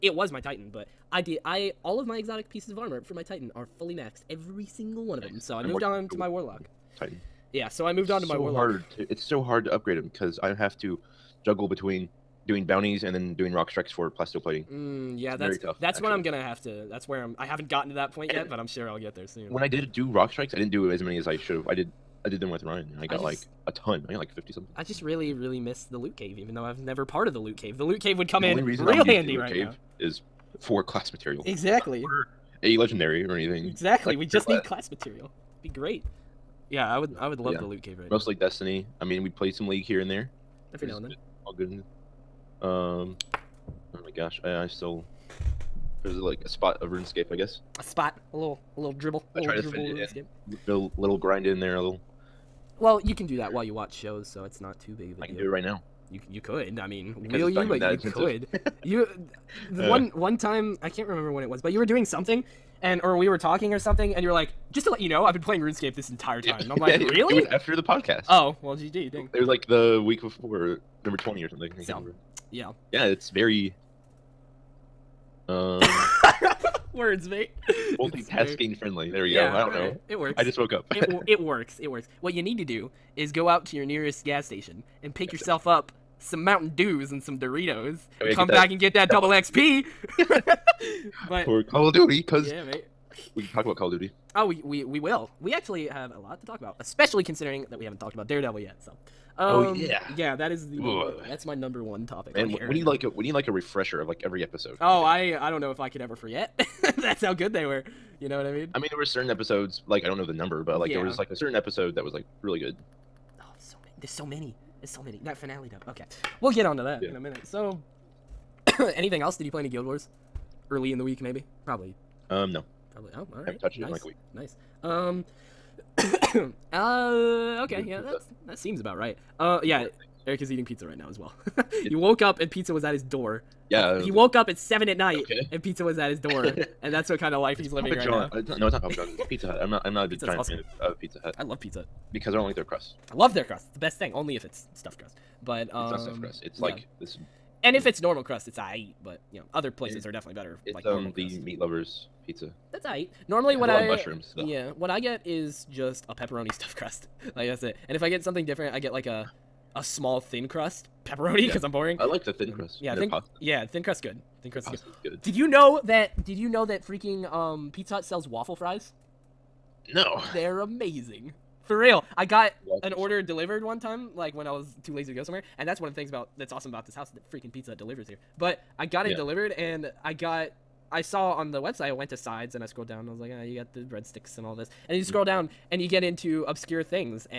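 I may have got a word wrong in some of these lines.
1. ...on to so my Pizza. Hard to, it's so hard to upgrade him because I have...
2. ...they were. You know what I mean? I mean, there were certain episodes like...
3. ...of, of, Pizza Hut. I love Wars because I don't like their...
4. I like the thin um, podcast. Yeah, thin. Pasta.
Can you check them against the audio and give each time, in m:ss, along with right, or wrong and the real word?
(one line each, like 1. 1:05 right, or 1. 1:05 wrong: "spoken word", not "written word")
1. 0:08 wrong: "Warlock", not "Pizza"
2. 1:47 right
3. 2:20 wrong: "Pizza", not "Wars"
4. 2:41 wrong: "crust", not "podcast".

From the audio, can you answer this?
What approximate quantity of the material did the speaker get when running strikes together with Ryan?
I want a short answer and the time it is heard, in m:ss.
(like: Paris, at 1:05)
Fifty something, at 0:24.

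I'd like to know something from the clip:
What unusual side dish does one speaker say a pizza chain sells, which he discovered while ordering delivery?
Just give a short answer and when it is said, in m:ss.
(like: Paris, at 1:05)
Waffle fries, at 2:48.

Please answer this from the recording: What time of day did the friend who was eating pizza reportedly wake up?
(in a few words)
7 at night.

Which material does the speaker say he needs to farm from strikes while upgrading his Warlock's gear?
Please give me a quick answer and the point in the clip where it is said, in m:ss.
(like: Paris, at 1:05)
Plasteel plating, at 0:14.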